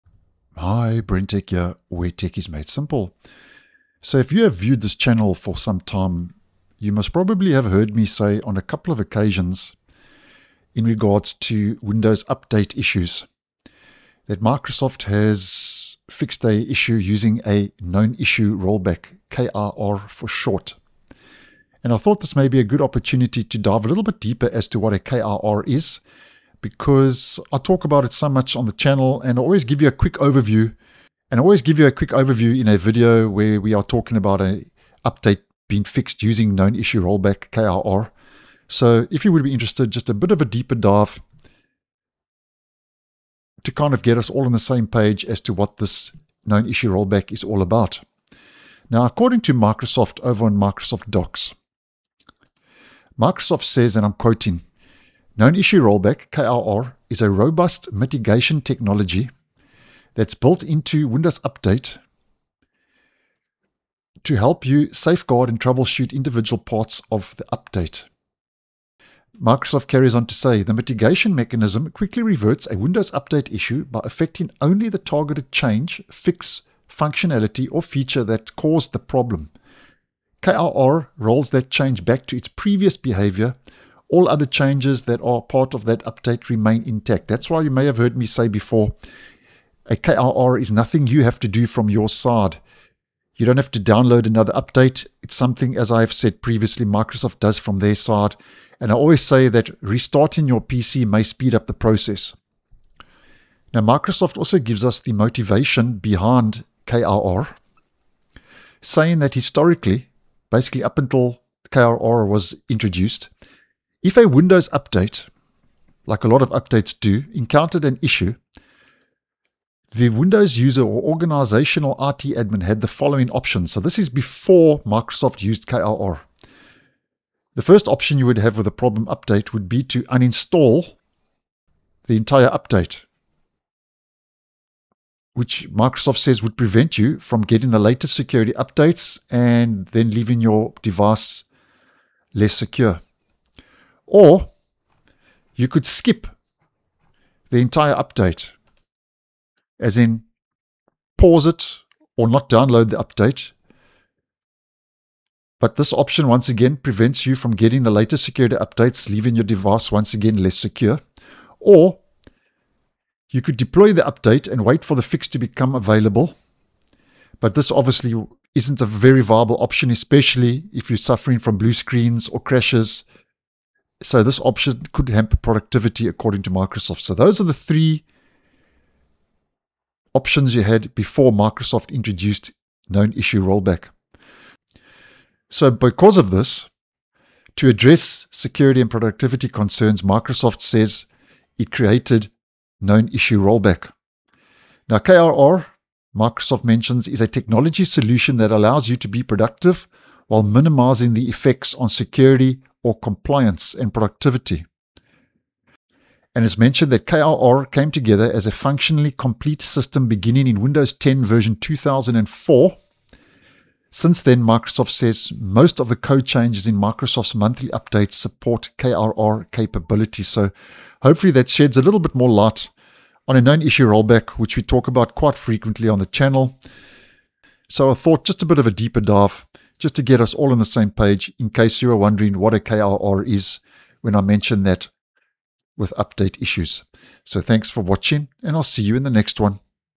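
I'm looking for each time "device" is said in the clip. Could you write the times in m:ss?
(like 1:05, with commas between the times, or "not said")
2:20, 2:39.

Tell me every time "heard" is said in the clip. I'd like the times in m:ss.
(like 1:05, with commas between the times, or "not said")
0:07, 1:27.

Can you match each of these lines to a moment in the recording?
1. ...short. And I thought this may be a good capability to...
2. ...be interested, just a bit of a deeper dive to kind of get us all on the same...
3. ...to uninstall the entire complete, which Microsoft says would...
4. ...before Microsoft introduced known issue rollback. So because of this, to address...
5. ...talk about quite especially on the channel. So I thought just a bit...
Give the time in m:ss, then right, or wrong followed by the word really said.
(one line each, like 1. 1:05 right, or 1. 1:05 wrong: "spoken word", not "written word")
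1. 0:20 wrong: "opportunity", not "capability"
2. 0:39 right
3. 2:09 wrong: "update", not "complete"
4. 3:00 right
5. 3:44 wrong: "frequently", not "especially".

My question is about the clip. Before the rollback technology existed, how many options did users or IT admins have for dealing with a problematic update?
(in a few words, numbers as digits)
3.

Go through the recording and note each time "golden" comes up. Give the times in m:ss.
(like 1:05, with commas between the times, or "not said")
not said.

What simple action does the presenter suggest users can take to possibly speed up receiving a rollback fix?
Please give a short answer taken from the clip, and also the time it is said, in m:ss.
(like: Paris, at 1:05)
Restarting your PC, at 1:39.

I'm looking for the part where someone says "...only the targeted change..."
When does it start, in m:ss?
1:14.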